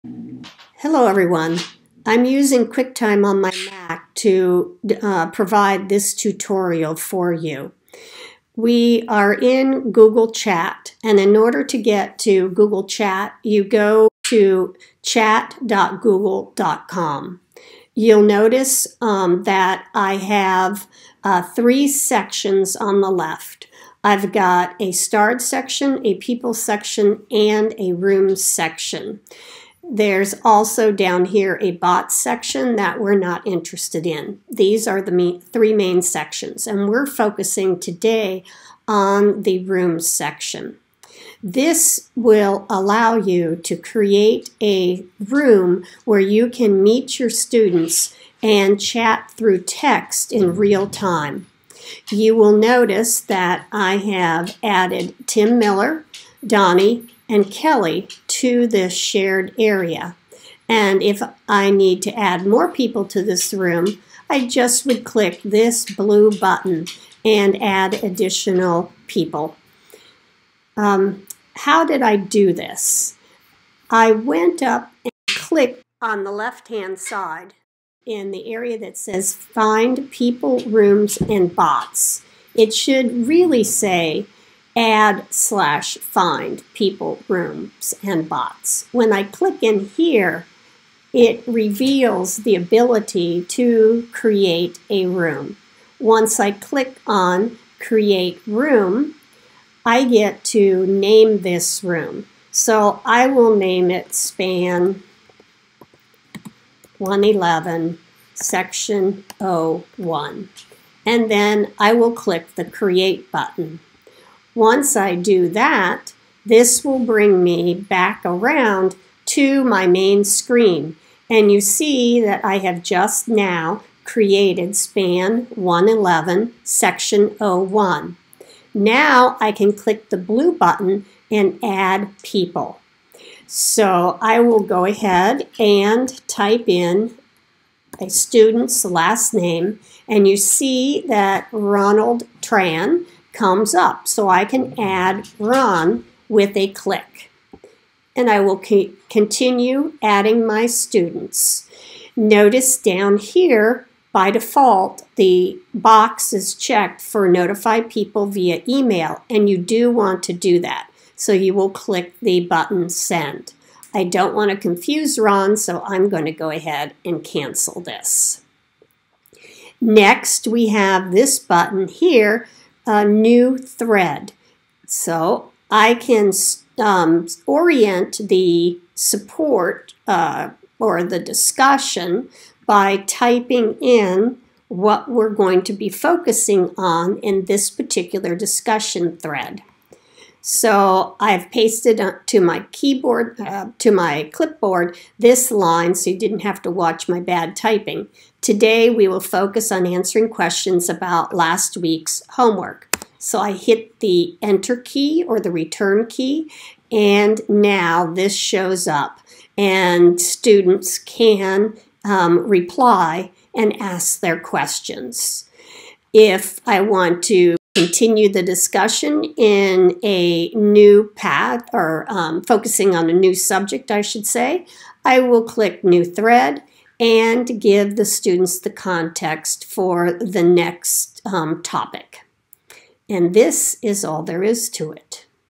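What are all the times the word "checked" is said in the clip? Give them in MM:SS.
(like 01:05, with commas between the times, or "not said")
02:36.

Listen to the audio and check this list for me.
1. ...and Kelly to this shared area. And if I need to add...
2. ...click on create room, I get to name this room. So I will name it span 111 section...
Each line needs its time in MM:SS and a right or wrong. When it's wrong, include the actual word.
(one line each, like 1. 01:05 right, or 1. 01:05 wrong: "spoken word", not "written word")
1. 00:57 right
2. 01:36 right.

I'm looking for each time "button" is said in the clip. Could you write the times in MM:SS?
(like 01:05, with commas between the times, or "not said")
01:06, 01:53, 02:10, 02:42, 02:51.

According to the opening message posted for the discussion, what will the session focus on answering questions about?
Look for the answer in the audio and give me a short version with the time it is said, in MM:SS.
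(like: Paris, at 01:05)
Last week's homework, at 03:21.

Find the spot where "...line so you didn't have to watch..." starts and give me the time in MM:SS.
03:15.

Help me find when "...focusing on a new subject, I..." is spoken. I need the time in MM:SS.
03:42.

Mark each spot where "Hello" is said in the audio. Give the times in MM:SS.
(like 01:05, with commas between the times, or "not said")
00:00.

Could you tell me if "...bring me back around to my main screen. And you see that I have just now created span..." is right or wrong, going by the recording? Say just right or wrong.
right.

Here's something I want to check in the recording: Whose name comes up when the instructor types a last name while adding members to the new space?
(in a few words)
Ronald Tran.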